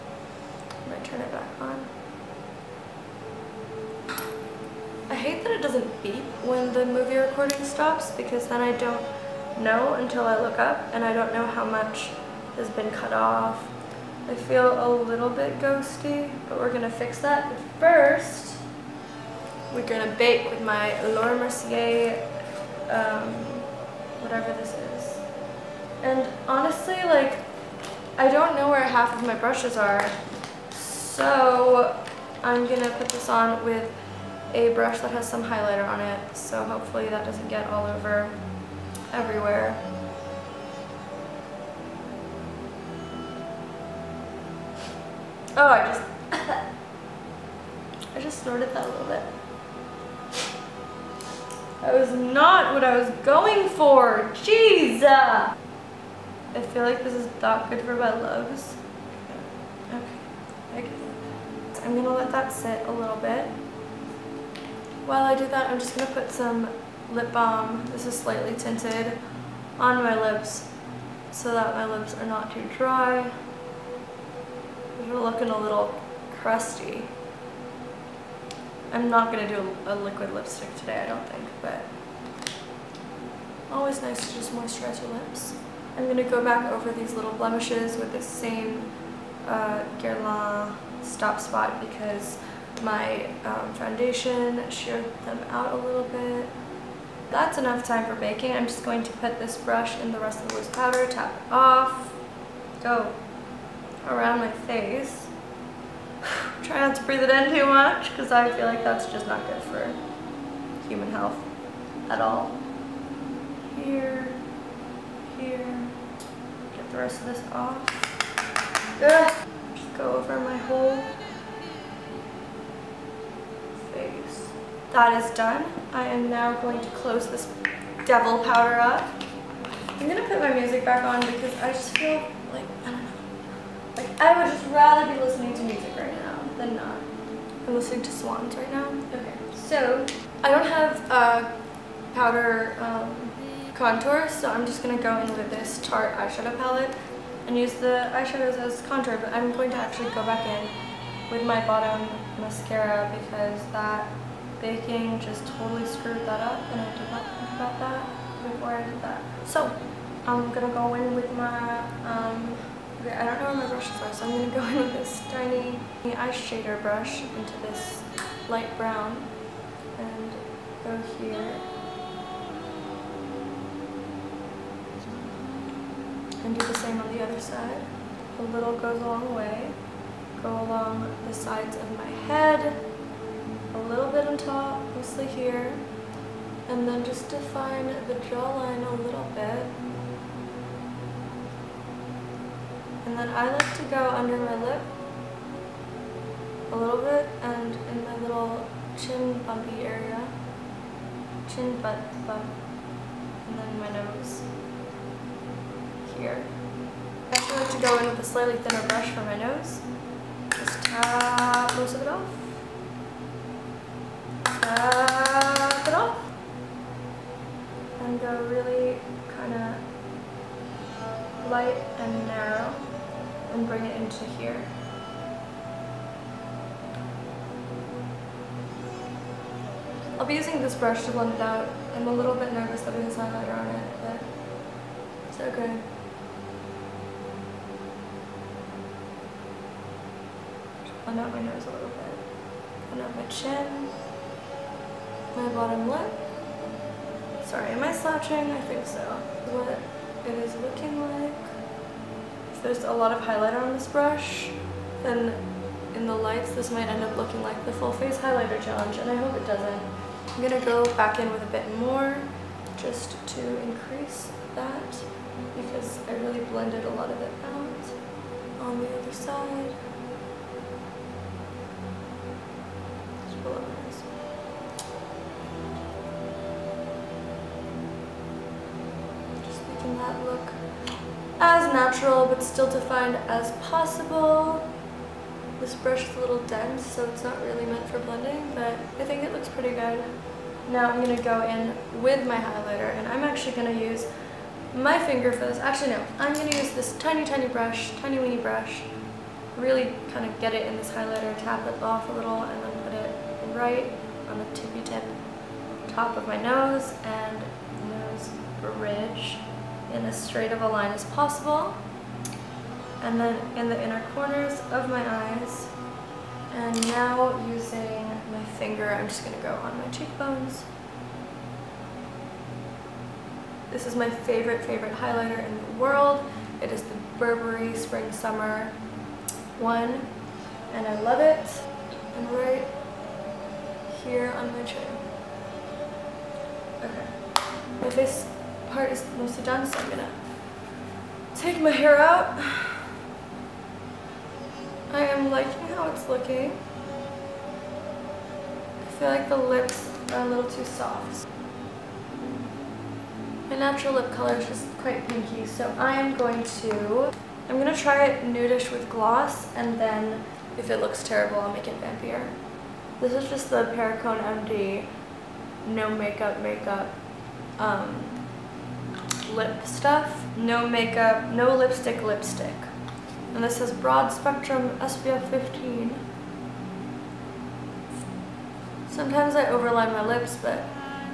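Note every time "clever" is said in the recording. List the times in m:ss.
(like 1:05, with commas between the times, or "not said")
not said.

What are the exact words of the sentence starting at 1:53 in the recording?
Here, here, get the rest of this off.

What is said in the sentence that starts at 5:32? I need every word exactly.
And right here on my chin.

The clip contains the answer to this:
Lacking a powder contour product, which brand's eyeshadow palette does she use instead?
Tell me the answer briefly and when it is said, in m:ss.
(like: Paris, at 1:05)
Tarte, at 2:25.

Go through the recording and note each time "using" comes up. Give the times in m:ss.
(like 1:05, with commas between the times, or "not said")
3:50, 5:17.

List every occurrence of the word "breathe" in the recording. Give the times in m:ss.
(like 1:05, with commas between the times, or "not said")
1:47.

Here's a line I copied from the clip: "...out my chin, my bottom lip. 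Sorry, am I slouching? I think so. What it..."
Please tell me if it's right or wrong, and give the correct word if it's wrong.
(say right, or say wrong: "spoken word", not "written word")
right.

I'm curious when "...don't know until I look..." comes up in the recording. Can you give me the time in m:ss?
0:08.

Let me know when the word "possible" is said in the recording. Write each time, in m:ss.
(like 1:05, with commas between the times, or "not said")
4:43, 5:11.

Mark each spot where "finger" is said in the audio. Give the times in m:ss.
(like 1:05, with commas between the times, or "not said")
4:54, 5:18.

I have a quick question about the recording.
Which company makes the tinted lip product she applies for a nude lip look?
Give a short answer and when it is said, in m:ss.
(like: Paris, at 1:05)
Perricone MD, at 6:03.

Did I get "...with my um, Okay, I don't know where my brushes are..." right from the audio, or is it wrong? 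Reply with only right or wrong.
right.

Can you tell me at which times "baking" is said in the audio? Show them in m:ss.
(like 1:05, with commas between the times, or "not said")
1:38, 2:34.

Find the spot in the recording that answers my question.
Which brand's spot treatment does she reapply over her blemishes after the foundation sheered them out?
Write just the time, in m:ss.
1:29.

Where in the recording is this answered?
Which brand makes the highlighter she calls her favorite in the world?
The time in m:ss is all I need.
5:27.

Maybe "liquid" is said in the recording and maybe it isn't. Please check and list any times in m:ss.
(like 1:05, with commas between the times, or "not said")
1:19.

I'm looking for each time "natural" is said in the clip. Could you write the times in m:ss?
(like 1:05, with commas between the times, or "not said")
4:42, 5:53.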